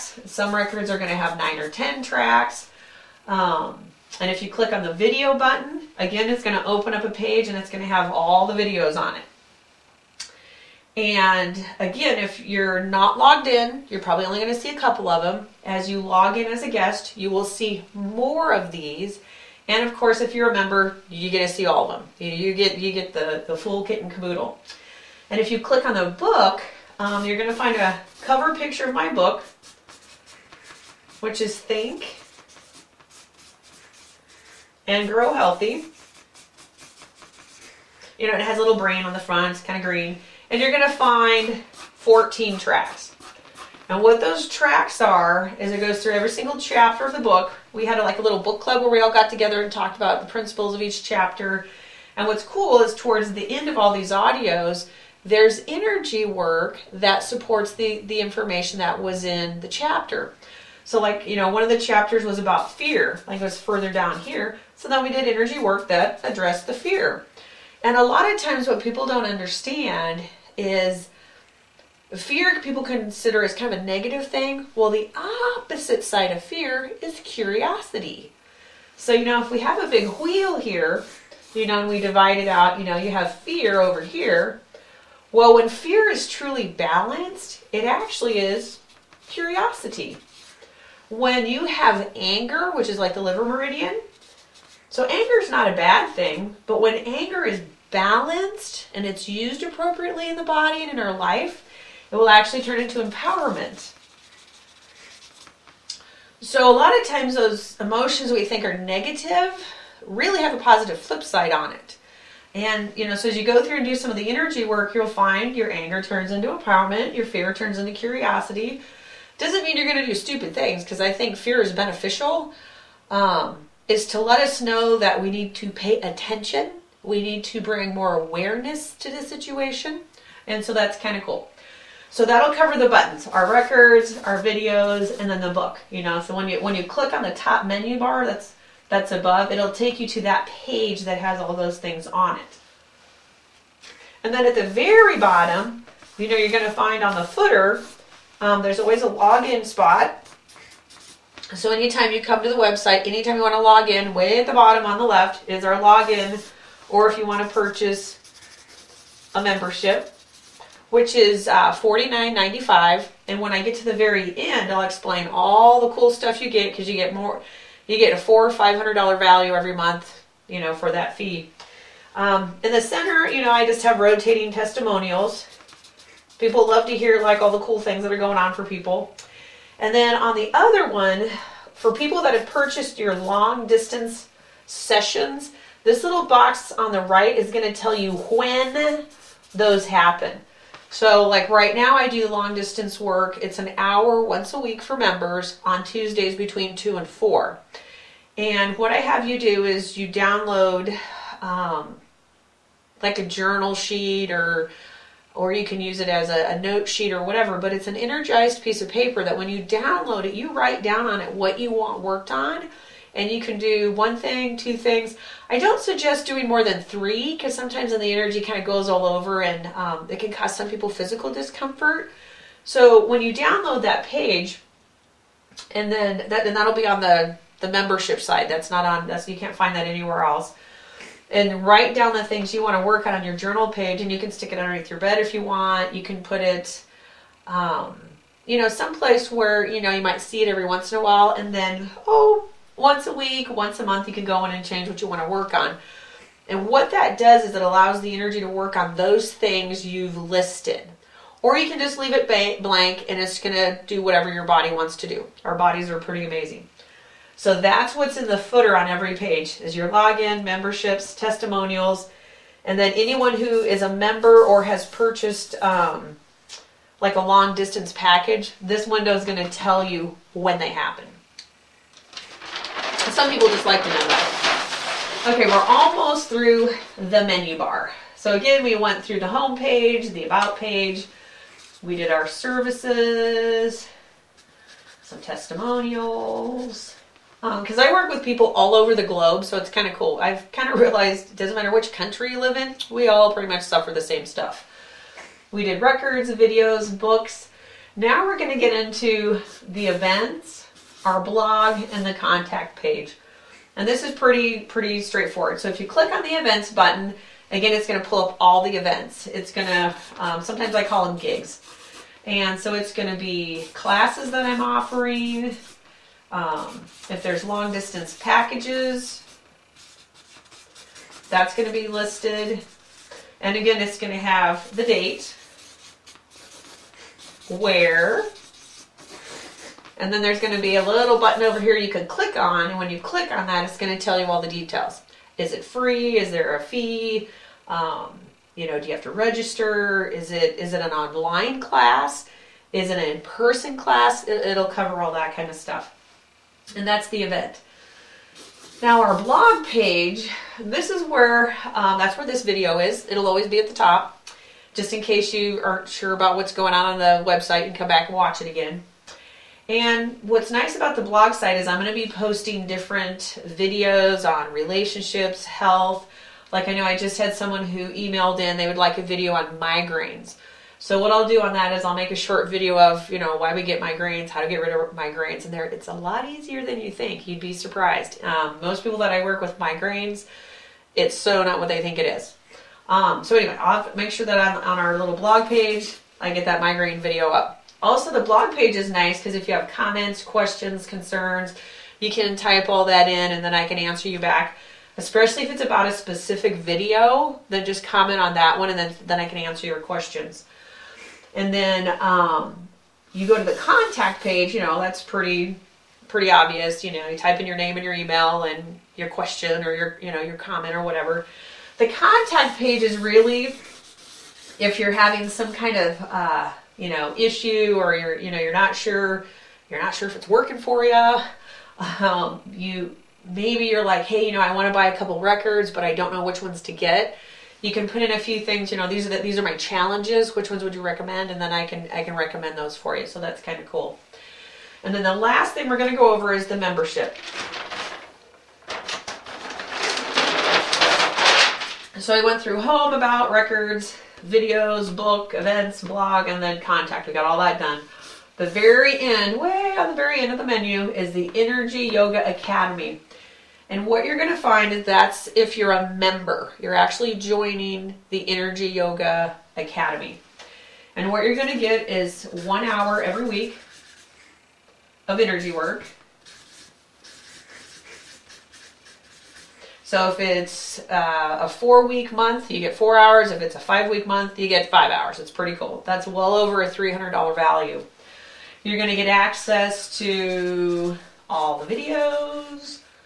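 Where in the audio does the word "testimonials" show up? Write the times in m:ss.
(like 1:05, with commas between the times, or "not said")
2:54, 4:21, 4:45.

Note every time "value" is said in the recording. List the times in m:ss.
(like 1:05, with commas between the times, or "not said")
2:49, 7:57.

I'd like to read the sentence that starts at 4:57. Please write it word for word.
Now we're going to get into the events our blog, and the contact page.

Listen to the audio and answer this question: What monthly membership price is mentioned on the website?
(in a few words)
$49.95.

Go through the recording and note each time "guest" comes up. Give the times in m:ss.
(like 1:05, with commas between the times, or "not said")
0:16.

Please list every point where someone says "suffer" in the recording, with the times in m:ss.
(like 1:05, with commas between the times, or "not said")
4:53.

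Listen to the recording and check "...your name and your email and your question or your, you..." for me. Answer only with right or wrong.
right.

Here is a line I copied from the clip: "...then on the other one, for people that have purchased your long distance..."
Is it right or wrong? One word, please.
right.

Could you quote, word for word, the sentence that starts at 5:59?
And what's nice about the blog site is I'm going to be posting different videos on relationships, health.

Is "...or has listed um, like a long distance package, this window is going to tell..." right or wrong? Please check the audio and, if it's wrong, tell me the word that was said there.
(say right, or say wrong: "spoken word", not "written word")
wrong: "purchased", not "listed".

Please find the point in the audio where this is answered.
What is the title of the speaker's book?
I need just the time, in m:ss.
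0:31.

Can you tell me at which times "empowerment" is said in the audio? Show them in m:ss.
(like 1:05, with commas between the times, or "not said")
1:43, 1:56.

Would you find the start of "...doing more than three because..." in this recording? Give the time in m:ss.
3:36.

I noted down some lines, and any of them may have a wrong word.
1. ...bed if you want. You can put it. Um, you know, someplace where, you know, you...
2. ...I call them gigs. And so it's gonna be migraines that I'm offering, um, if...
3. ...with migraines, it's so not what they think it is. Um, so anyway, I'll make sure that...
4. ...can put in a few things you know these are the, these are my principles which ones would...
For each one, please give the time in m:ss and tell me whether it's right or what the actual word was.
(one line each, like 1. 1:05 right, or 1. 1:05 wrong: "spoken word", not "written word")
1. 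3:54 right
2. 5:10 wrong: "classes", not "migraines"
3. 6:19 right
4. 7:07 wrong: "challenges", not "principles".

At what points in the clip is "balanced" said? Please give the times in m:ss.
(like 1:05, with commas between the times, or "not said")
1:26, 1:37.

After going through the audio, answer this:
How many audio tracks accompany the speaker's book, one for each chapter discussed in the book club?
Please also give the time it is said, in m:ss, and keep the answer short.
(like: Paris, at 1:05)
14, at 0:41.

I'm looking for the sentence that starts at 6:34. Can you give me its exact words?
Especially if it's about a specific video, then just comment on that one and then, then I can answer your questions.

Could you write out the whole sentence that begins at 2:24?
And then at the very bottom, you know, you're going to find on the footer, um, there's always a login spot.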